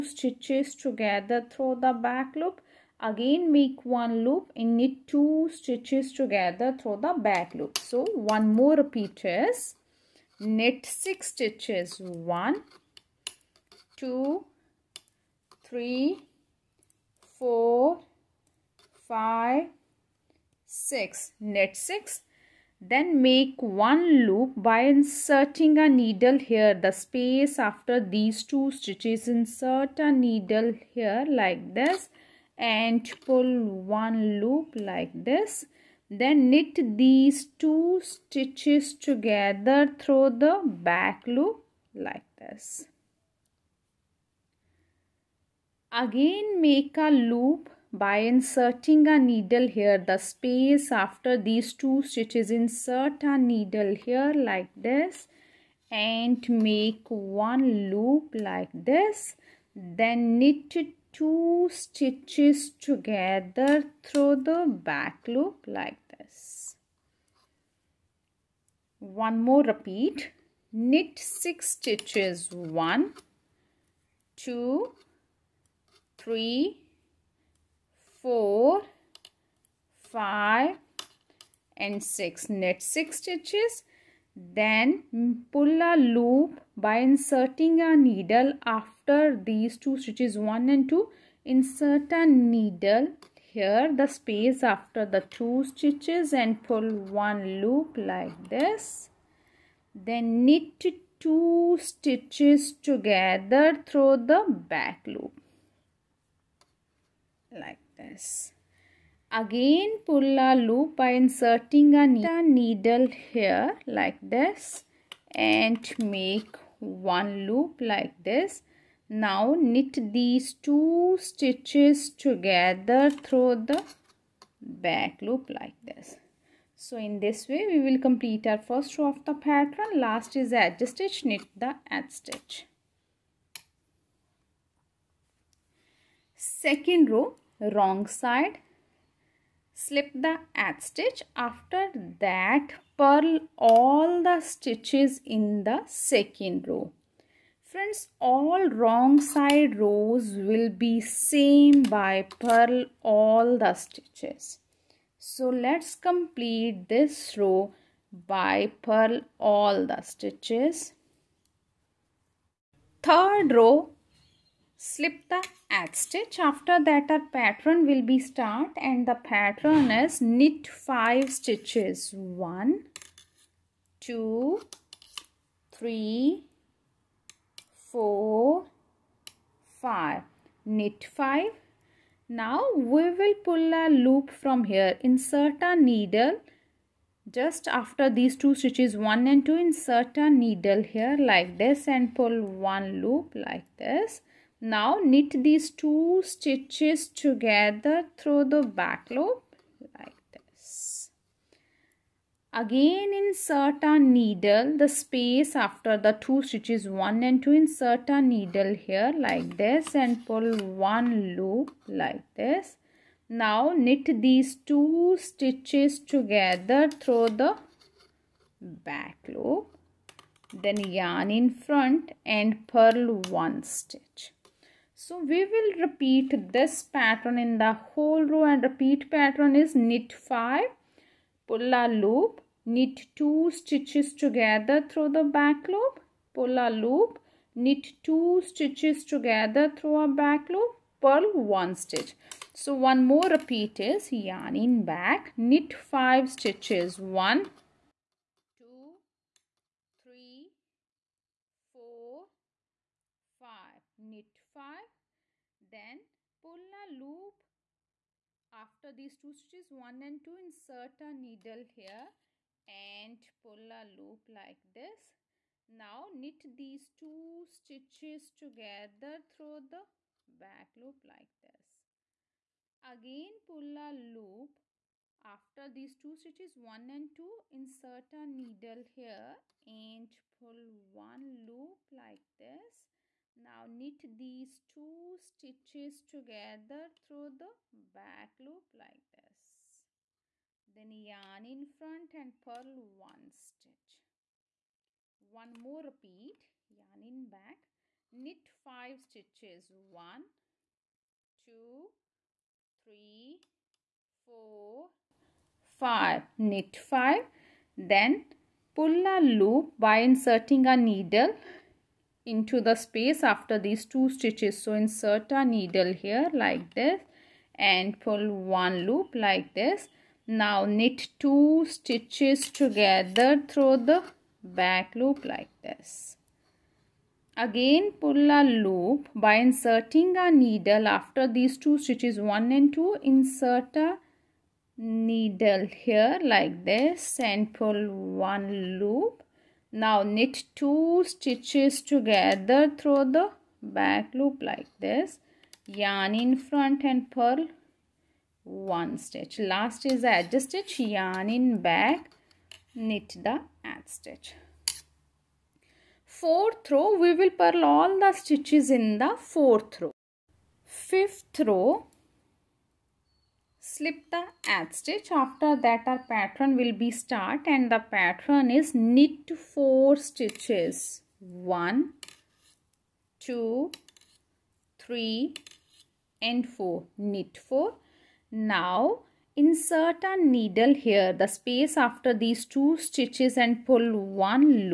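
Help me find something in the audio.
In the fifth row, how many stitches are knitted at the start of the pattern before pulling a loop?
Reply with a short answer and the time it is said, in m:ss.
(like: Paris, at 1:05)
4, at 6:08.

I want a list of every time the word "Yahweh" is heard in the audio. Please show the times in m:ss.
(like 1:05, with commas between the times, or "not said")
not said.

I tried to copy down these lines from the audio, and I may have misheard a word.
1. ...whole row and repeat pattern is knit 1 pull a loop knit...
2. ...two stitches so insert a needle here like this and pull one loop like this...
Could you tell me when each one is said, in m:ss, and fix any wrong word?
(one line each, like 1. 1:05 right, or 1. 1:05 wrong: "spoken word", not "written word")
1. 3:47 wrong: "5", not "1"
2. 5:13 right.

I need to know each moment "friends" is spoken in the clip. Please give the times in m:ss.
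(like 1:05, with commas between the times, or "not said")
2:27.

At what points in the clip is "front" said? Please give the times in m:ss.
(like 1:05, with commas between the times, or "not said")
3:41, 4:51, 5:46.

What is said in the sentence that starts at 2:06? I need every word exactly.
So in this way we will complete our first row of the pattern.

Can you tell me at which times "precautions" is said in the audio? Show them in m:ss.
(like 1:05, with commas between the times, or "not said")
not said.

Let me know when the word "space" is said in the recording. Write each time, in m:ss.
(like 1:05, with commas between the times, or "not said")
0:26, 0:50, 1:34, 3:24, 5:12, 6:21.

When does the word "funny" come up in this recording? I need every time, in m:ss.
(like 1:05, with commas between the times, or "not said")
not said.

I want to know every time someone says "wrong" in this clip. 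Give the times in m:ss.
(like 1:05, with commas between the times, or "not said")
2:17, 2:28.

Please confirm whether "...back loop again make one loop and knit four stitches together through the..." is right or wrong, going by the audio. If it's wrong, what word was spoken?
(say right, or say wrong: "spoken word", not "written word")
wrong: "two", not "four".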